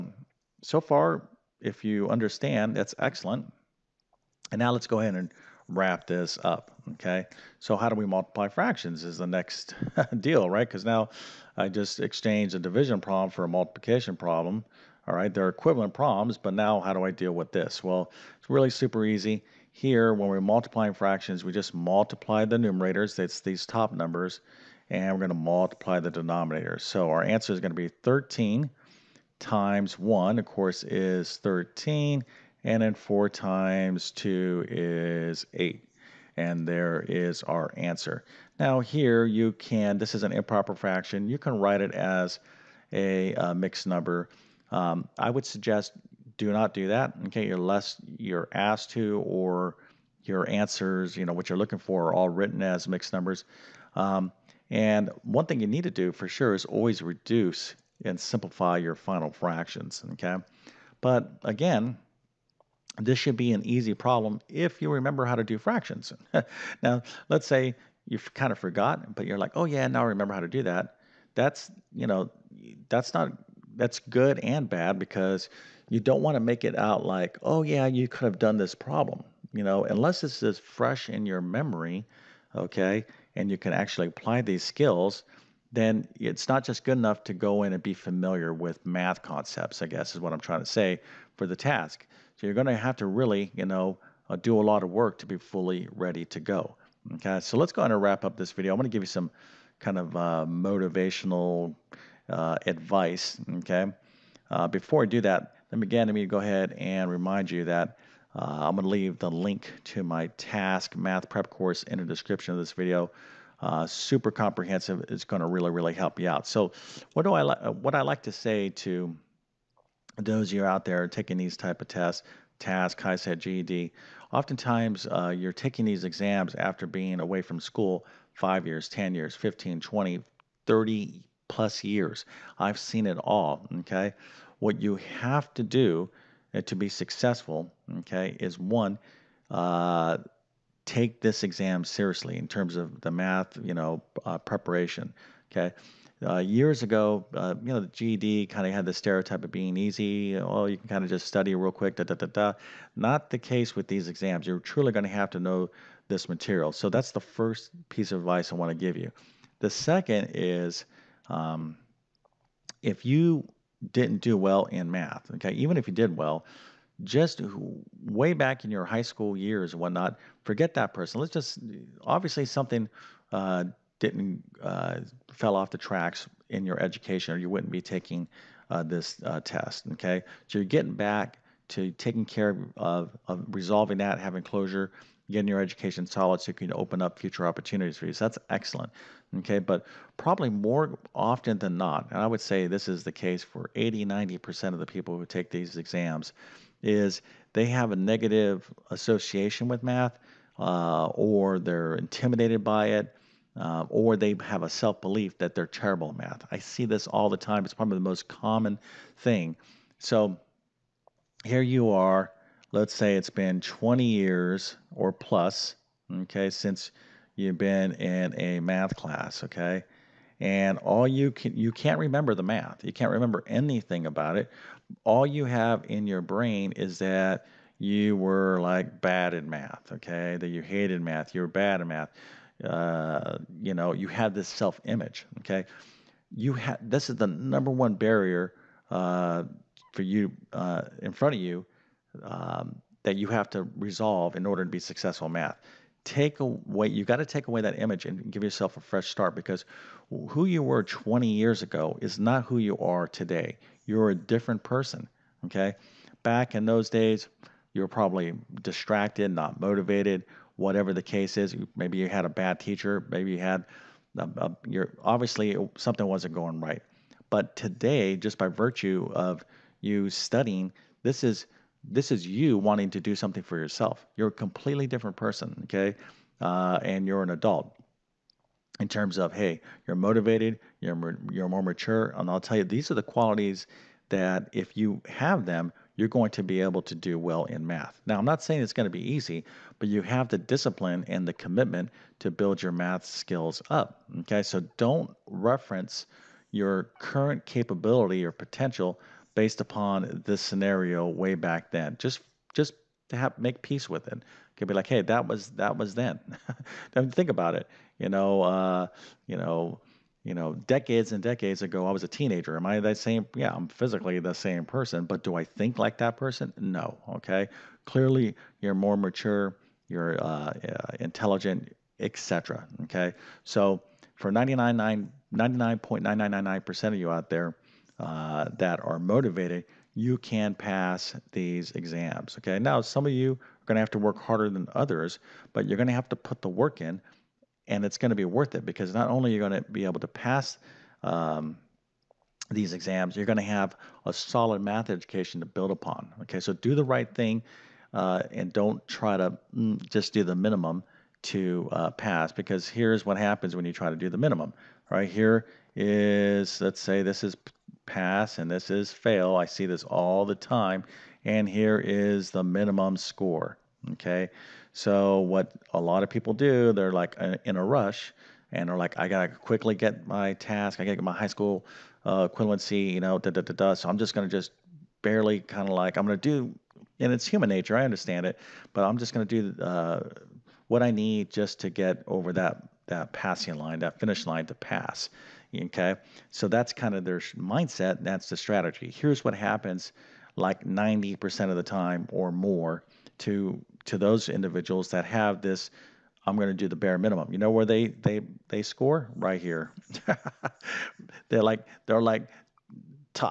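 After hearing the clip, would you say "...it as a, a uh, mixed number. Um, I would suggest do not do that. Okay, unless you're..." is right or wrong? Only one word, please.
right.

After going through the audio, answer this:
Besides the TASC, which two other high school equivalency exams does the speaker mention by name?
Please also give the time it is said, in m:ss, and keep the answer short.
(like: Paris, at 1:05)
HiSET, GED, at 2:02.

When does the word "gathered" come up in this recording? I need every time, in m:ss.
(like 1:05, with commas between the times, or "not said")
not said.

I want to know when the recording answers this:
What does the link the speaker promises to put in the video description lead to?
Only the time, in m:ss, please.
1:50.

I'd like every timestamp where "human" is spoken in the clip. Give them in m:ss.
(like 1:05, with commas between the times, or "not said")
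6:17.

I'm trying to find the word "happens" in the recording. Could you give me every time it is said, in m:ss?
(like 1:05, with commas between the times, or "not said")
5:53, 6:29.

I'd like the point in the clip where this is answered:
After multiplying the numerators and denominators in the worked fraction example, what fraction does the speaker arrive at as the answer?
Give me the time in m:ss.
0:31.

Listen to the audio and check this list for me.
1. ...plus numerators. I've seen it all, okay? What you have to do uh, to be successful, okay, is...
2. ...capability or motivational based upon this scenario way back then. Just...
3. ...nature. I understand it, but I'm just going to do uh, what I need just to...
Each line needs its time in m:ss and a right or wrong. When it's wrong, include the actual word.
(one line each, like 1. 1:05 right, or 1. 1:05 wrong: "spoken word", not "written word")
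1. 2:11 wrong: "years", not "numerators"
2. 4:57 wrong: "potential", not "motivational"
3. 6:17 right.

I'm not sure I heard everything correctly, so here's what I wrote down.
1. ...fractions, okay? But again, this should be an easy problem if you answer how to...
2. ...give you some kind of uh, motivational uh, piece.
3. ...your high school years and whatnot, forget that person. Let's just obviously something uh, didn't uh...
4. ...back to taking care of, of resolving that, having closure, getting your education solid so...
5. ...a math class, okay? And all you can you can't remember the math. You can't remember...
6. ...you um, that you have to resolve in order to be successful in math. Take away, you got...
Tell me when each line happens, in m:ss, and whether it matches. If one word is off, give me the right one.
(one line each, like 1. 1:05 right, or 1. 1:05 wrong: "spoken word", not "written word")
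1. 0:59 wrong: "remember", not "answer"
2. 1:38 wrong: "advice", not "piece"
3. 2:48 right
4. 3:00 right
5. 3:38 right
6. 4:01 right.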